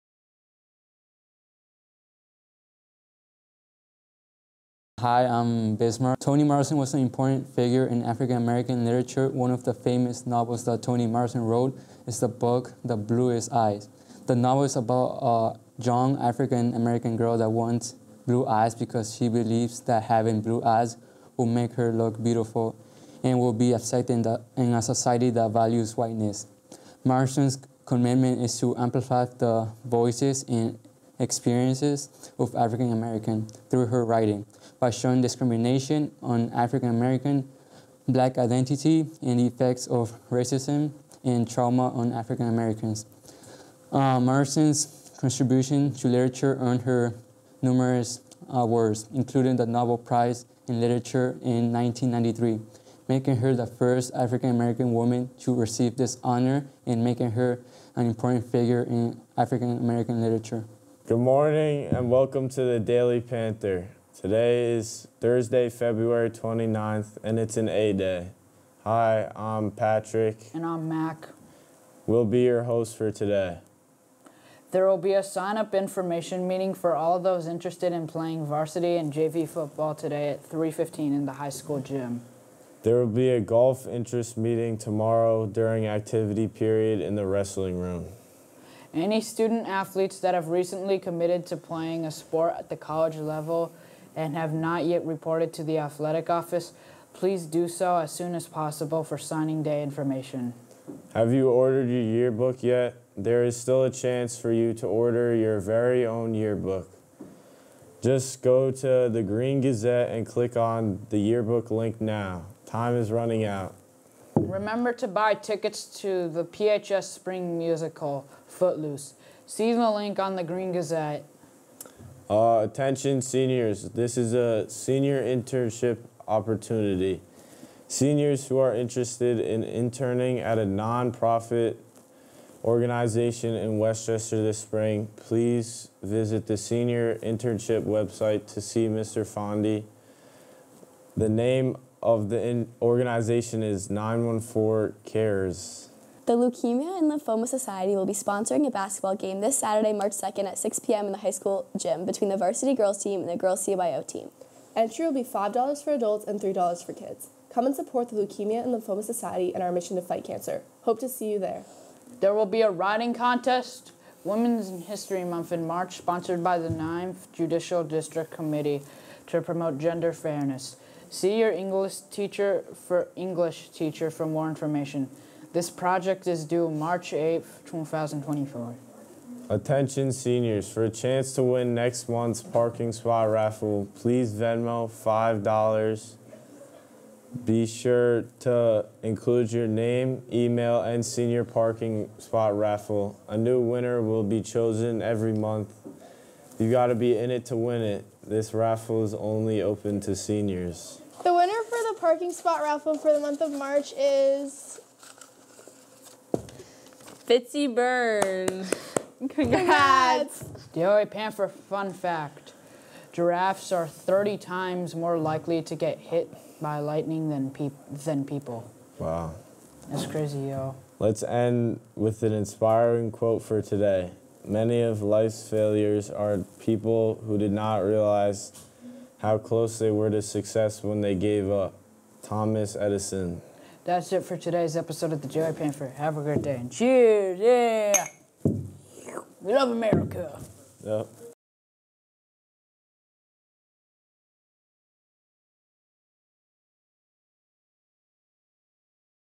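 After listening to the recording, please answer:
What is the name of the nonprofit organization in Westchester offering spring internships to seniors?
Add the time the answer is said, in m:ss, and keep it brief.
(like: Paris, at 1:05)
914 Cares, at 2:23.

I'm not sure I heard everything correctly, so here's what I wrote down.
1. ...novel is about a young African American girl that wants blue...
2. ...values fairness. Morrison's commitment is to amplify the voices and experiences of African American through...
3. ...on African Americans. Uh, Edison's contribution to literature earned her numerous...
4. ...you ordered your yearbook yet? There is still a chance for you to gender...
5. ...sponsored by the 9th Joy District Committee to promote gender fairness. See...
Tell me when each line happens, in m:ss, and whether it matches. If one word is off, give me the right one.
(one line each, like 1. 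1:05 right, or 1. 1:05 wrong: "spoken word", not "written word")
1. 0:14 right
2. 0:25 wrong: "whiteness", not "fairness"
3. 0:41 wrong: "Morrison", not "Edison"
4. 1:41 wrong: "order", not "gender"
5. 2:45 wrong: "Judicial", not "Joy".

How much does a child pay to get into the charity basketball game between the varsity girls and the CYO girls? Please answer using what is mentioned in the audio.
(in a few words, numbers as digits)
$3.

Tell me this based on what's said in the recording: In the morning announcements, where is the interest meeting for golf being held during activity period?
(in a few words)
the wrestling room.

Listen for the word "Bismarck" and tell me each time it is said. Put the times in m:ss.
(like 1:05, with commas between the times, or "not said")
0:05.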